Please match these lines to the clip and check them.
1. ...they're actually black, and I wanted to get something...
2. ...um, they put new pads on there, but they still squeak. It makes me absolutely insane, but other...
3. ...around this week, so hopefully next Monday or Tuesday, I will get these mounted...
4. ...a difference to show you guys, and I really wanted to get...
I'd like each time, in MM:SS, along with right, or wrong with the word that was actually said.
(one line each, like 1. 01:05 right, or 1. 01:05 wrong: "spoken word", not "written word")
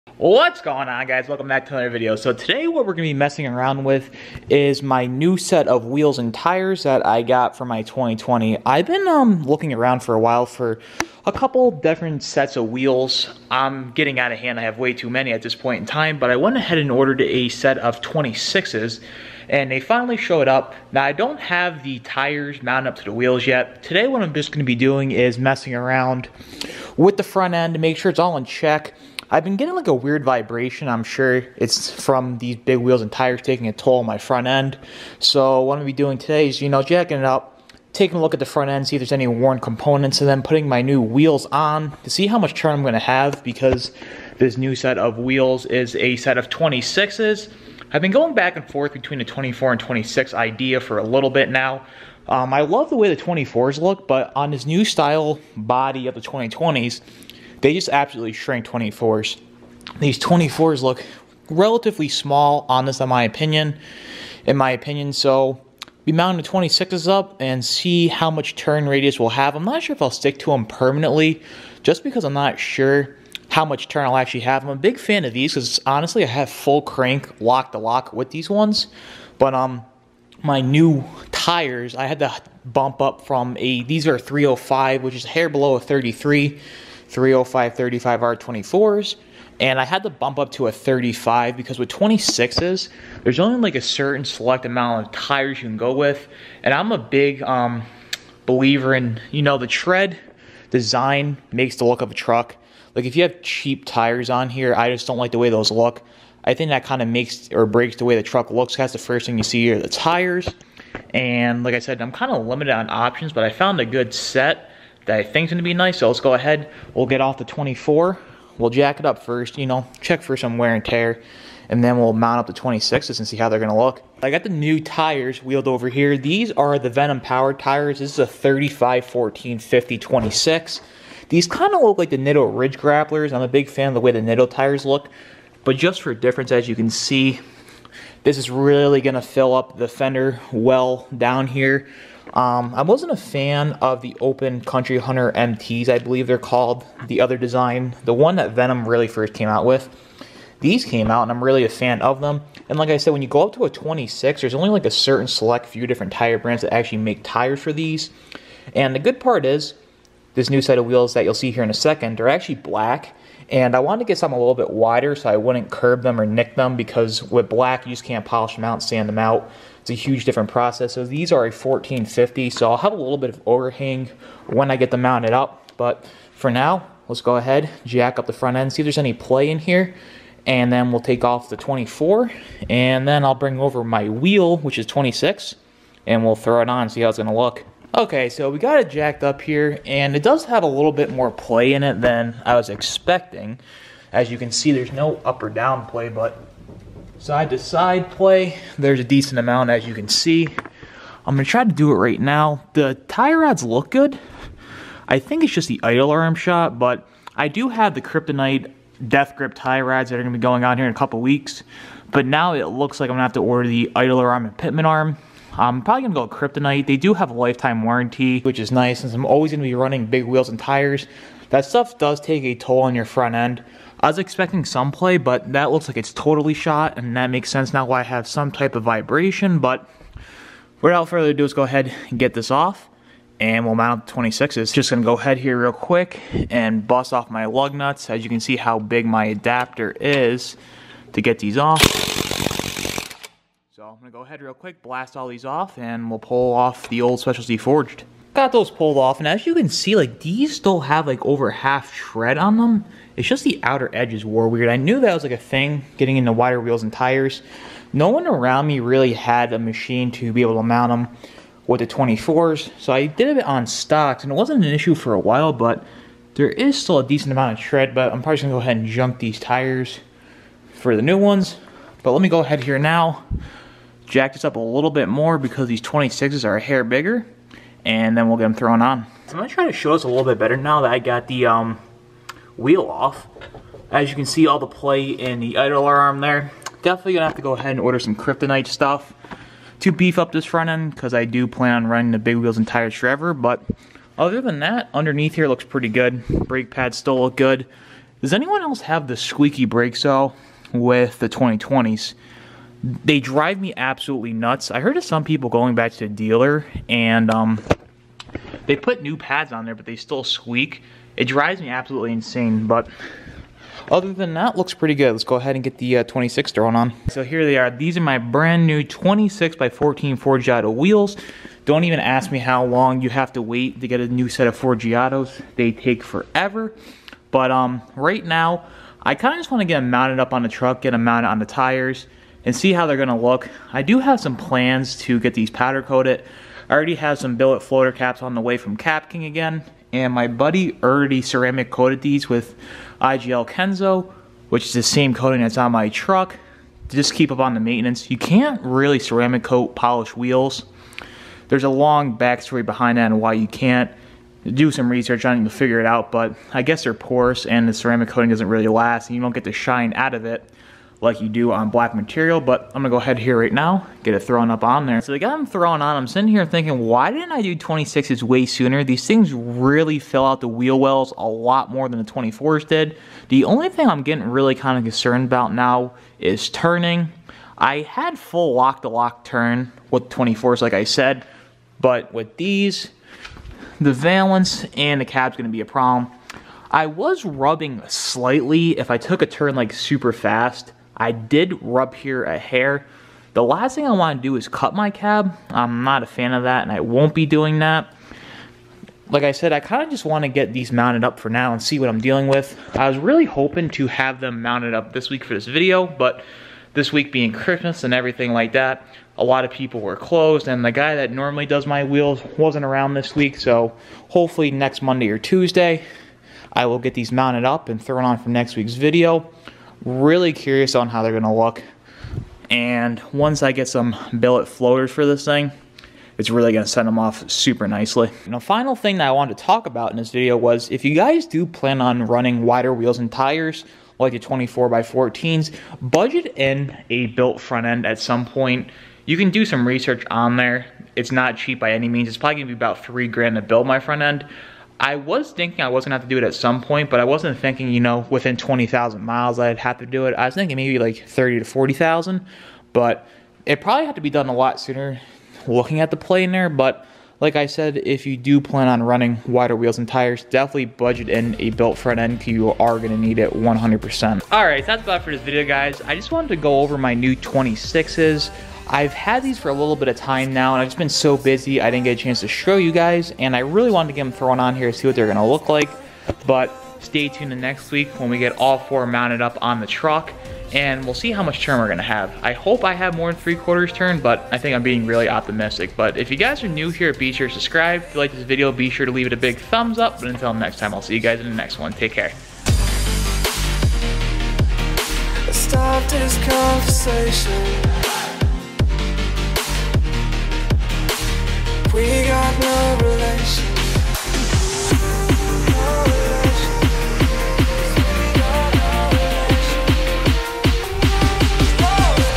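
1. 02:42 right
2. 05:07 wrong: "drives", not "makes"
3. 06:52 right
4. 07:51 wrong: "chance", not "difference".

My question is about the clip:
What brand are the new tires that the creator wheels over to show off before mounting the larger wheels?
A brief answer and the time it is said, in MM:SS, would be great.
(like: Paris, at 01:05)
Venom Power, at 02:06.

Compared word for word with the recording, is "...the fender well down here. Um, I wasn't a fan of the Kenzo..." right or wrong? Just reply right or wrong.
wrong.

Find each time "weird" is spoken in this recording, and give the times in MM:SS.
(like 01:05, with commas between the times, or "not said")
00:29, 04:14.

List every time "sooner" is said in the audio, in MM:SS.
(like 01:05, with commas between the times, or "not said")
06:08, 07:34.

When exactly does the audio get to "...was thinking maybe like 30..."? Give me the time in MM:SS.
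07:30.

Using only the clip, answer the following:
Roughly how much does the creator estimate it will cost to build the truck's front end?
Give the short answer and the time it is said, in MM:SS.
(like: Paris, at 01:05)
$3,000, at 07:22.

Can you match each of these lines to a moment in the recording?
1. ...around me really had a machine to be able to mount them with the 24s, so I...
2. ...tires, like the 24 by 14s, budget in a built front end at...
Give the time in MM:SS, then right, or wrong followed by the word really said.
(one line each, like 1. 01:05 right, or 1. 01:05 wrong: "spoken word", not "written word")
1. 04:18 right
2. 07:13 right.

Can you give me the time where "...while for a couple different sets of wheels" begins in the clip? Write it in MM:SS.
00:10.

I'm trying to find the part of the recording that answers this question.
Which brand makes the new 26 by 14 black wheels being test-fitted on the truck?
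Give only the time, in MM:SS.
05:20.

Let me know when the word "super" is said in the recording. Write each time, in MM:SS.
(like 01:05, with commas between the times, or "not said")
06:29, 07:07.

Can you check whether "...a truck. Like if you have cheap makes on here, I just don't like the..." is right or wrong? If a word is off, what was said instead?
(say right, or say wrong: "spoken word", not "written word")
wrong: "tires", not "makes".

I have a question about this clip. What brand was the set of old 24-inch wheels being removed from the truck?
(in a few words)
Specialty Forged.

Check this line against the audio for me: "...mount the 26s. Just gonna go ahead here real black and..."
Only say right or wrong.
wrong.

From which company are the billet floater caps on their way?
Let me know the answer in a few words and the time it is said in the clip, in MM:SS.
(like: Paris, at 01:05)
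Cap King, at 05:38.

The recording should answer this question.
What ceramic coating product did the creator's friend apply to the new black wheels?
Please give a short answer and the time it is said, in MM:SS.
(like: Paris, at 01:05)
IGL Kenzo, at 05:43.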